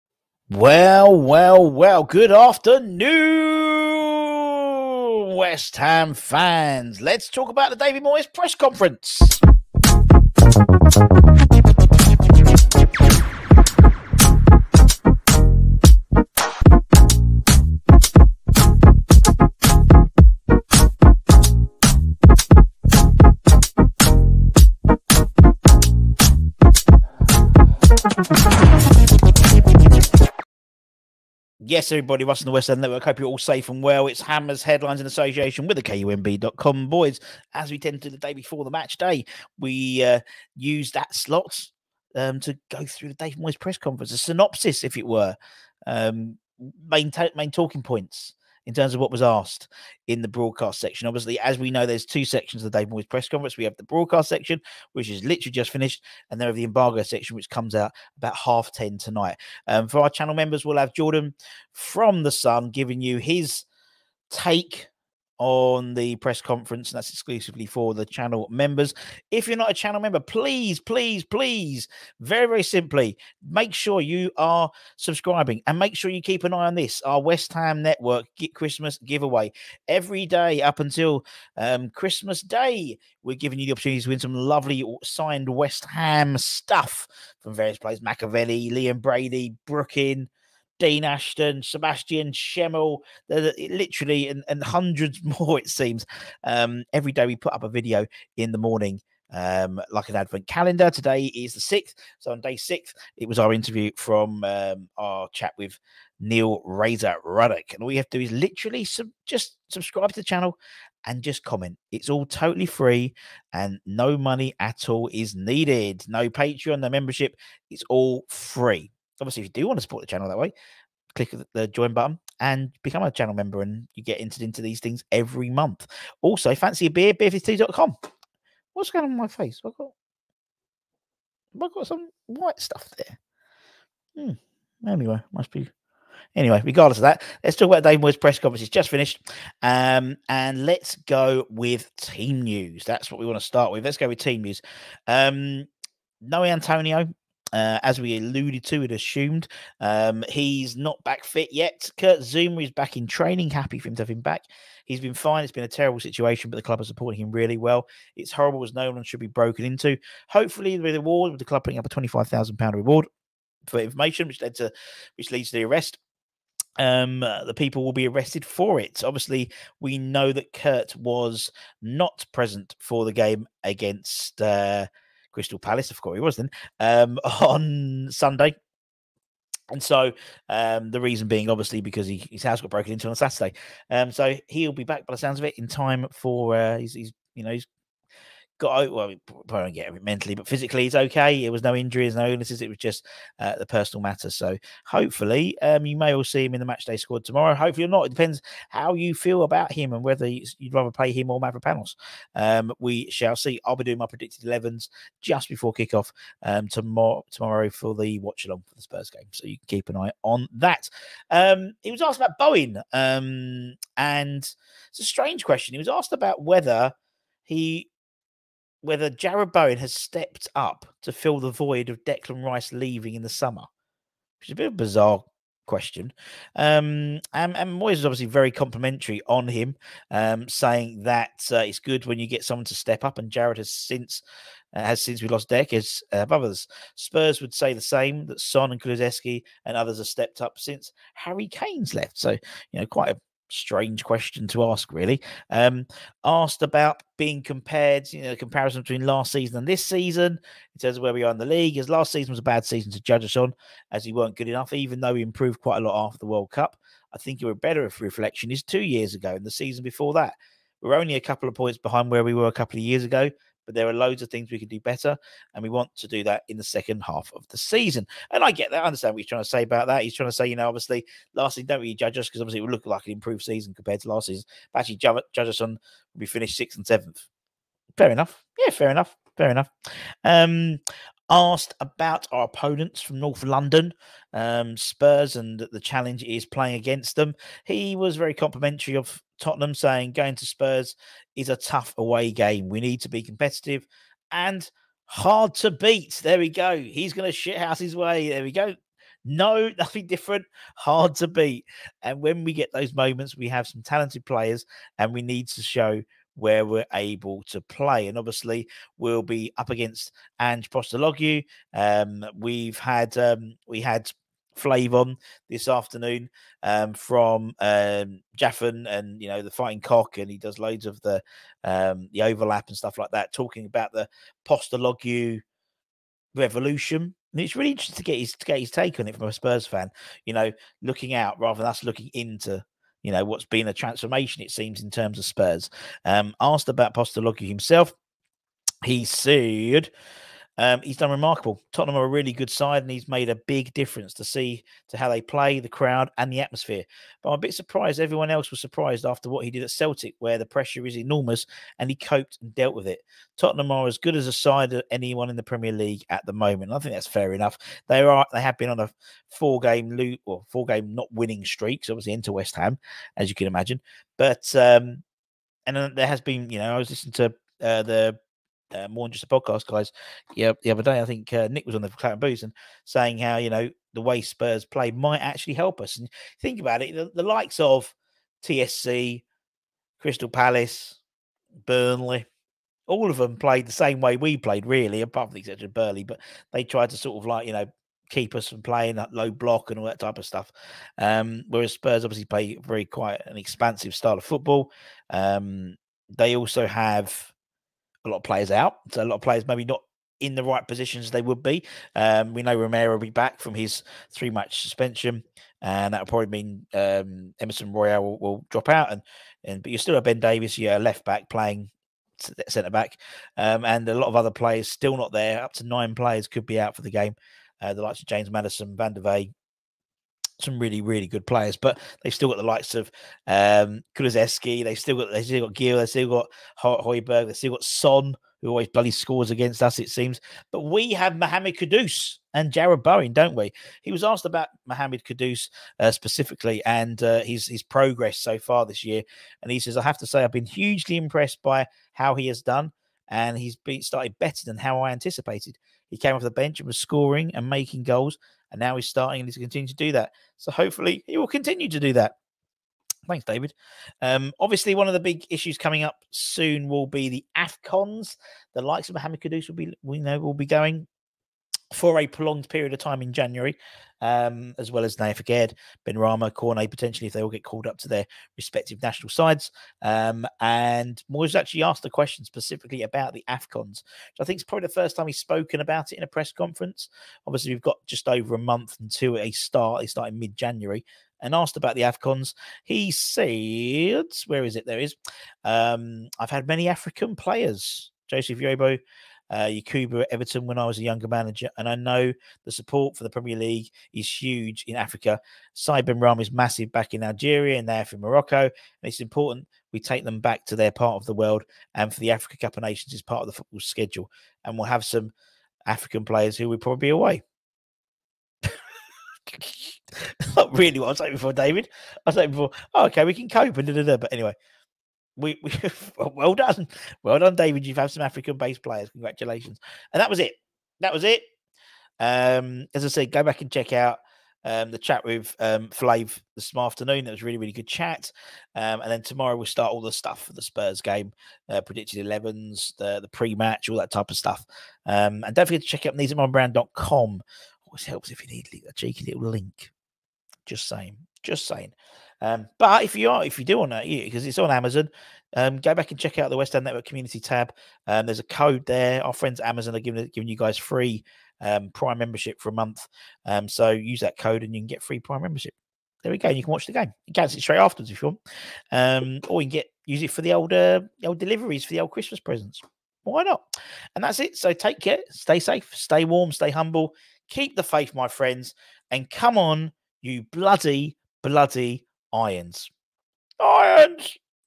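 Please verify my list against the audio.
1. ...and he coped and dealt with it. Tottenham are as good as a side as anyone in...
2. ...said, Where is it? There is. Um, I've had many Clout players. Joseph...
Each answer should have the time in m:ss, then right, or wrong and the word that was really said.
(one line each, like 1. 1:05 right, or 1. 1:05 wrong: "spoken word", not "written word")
1. 5:51 right
2. 8:02 wrong: "African", not "Clout".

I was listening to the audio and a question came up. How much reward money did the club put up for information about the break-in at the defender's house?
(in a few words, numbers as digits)
£25,000.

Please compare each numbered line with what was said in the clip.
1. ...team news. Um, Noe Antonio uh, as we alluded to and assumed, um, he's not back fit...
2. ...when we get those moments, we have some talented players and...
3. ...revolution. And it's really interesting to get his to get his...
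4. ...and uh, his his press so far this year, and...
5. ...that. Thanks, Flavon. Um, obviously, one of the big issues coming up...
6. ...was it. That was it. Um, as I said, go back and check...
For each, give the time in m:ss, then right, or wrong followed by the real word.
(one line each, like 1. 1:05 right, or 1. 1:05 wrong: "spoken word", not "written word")
1. 2:24 right
2. 5:02 right
3. 5:26 right
4. 7:16 wrong: "progress", not "press"
5. 7:31 wrong: "David", not "Flavon"
6. 8:40 right.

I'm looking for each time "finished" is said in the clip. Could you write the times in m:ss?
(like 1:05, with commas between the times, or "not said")
0:55, 2:18, 4:36.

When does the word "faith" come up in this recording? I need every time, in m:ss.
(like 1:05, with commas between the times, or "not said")
9:27.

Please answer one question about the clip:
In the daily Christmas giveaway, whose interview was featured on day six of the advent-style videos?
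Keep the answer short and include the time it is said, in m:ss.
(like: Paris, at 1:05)
Neil Razor Ruddock, at 1:46.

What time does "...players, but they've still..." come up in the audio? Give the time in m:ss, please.
7:01.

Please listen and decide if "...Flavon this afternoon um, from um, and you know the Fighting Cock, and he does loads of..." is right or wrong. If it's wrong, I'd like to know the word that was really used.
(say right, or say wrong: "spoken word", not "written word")
right.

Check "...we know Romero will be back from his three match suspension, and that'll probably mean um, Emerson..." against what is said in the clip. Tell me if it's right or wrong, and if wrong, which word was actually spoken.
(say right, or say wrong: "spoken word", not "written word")
right.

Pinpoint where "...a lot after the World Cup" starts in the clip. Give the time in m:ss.
4:15.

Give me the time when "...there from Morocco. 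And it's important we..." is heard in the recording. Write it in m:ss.
8:17.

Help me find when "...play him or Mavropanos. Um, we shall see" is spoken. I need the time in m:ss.
3:20.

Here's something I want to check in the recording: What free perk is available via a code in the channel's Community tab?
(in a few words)
Prime membership for a month.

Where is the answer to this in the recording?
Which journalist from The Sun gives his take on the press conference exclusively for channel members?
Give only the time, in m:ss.
1:00.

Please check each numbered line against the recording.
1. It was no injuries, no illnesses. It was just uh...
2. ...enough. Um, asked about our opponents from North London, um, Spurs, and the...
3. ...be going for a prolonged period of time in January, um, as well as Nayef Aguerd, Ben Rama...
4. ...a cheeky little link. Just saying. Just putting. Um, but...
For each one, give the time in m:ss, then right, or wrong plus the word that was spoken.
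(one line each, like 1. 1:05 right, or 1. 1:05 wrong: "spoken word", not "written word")
1. 3:11 right
2. 4:39 right
3. 7:40 right
4. 8:58 wrong: "saying", not "putting".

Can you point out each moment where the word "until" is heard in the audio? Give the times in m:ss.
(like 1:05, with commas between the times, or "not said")
1:20, 7:58.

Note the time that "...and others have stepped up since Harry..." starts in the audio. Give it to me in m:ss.
3:59.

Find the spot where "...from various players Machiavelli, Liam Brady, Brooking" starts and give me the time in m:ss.
1:27.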